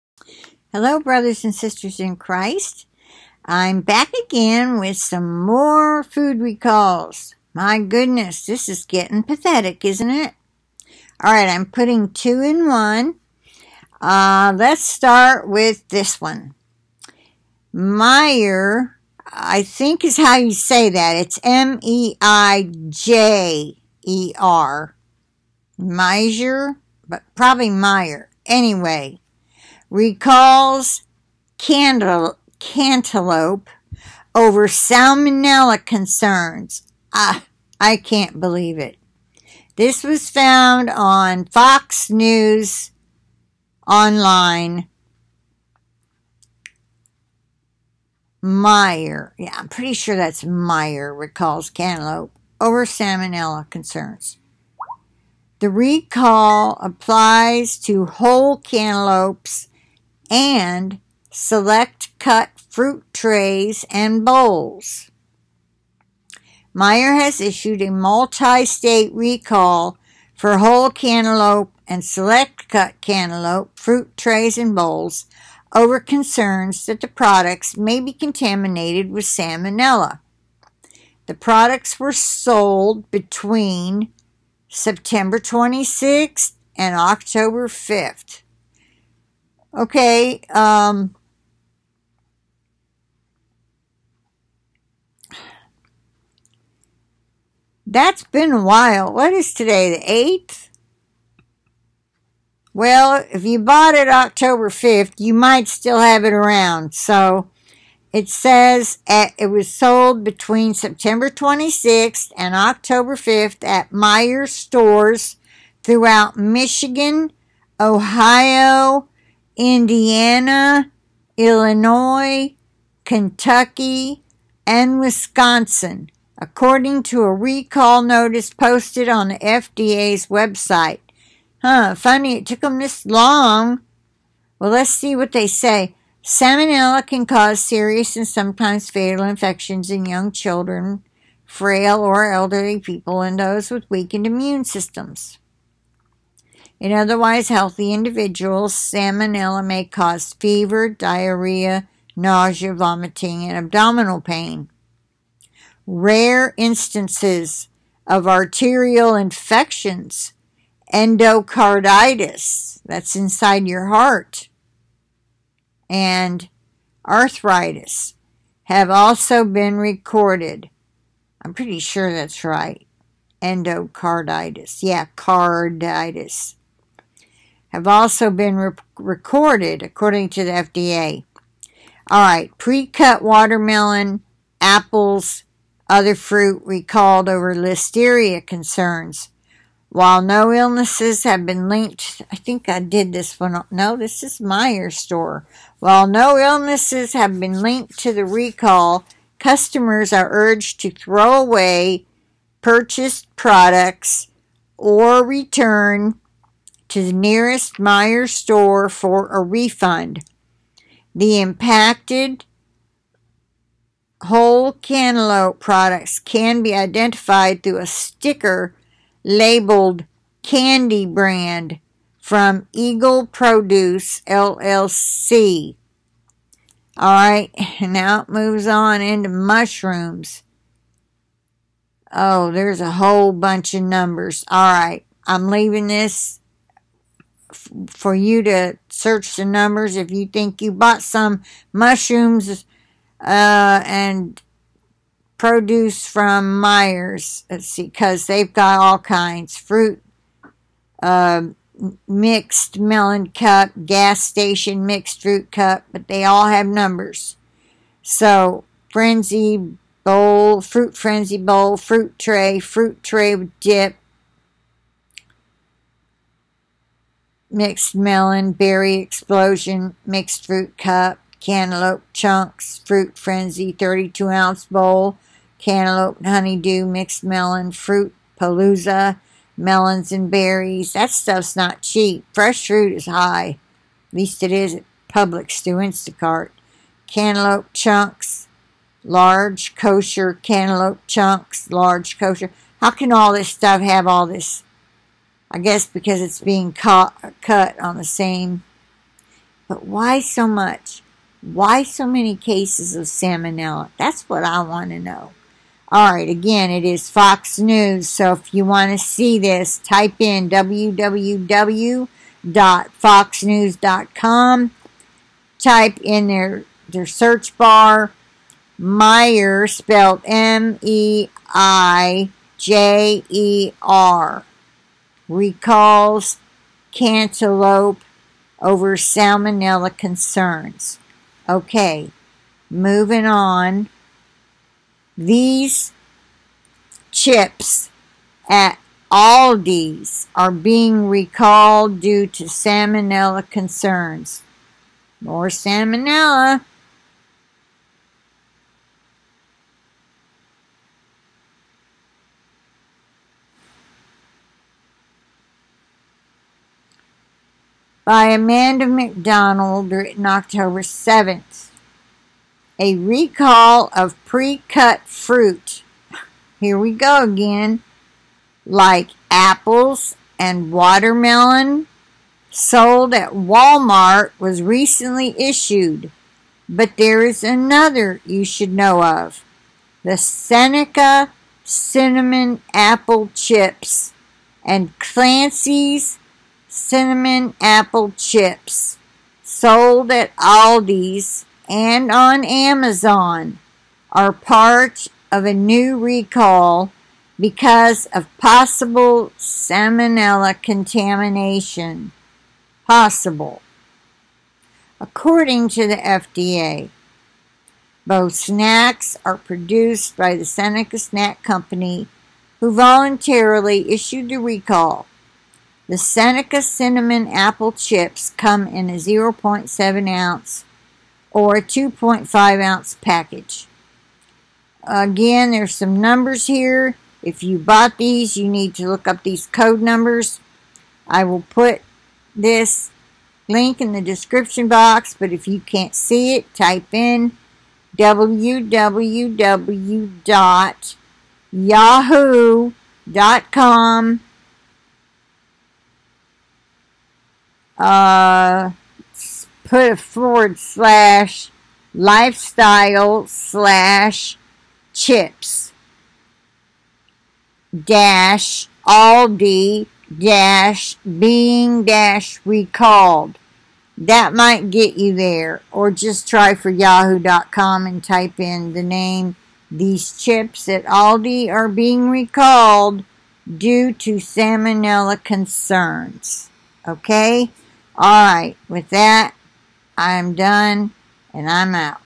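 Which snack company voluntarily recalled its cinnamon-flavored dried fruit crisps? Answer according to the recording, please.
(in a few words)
Seneca Snack Company.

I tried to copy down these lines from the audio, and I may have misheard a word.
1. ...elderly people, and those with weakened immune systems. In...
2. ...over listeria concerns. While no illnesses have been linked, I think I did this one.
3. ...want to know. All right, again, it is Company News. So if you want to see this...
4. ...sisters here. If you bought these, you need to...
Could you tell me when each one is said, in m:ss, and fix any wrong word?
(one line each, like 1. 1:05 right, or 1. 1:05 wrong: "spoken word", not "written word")
1. 2:22 right
2. 3:07 right
3. 5:04 wrong: "Fox", not "Company"
4. 7:05 wrong: "numbers", not "sisters".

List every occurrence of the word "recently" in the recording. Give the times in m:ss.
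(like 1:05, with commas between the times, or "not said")
6:14.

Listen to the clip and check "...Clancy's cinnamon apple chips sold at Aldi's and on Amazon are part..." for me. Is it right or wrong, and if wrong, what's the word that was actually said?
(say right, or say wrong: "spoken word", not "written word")
right.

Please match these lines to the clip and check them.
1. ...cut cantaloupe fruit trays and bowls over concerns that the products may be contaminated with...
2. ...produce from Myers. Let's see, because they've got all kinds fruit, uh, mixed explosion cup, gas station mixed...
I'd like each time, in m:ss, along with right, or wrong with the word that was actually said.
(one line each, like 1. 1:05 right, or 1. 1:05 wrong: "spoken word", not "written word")
1. 1:12 right
2. 4:05 wrong: "melon", not "explosion".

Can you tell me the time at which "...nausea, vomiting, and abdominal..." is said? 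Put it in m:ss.
2:32.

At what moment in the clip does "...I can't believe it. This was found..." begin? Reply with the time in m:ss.
0:37.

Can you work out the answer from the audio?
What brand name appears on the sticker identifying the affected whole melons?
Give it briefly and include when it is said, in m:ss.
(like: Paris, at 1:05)
Candy Brand, at 3:40.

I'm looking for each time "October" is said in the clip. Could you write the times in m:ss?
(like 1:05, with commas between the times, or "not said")
1:26, 1:44, 1:52, 6:00.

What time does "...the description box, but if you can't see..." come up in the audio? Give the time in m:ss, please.
7:13.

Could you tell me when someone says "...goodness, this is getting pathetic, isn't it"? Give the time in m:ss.
0:07.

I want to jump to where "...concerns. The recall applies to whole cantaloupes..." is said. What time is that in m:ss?
0:53.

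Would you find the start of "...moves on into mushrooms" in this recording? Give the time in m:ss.
3:48.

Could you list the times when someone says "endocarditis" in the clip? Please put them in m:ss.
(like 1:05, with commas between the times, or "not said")
2:40, 2:53.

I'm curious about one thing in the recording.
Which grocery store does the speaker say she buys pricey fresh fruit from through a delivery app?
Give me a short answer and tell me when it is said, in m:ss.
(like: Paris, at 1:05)
Publix, at 4:45.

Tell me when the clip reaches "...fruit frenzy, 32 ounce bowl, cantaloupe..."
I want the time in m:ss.
4:32.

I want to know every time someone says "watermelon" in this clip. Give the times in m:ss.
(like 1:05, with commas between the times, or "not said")
3:03, 6:10.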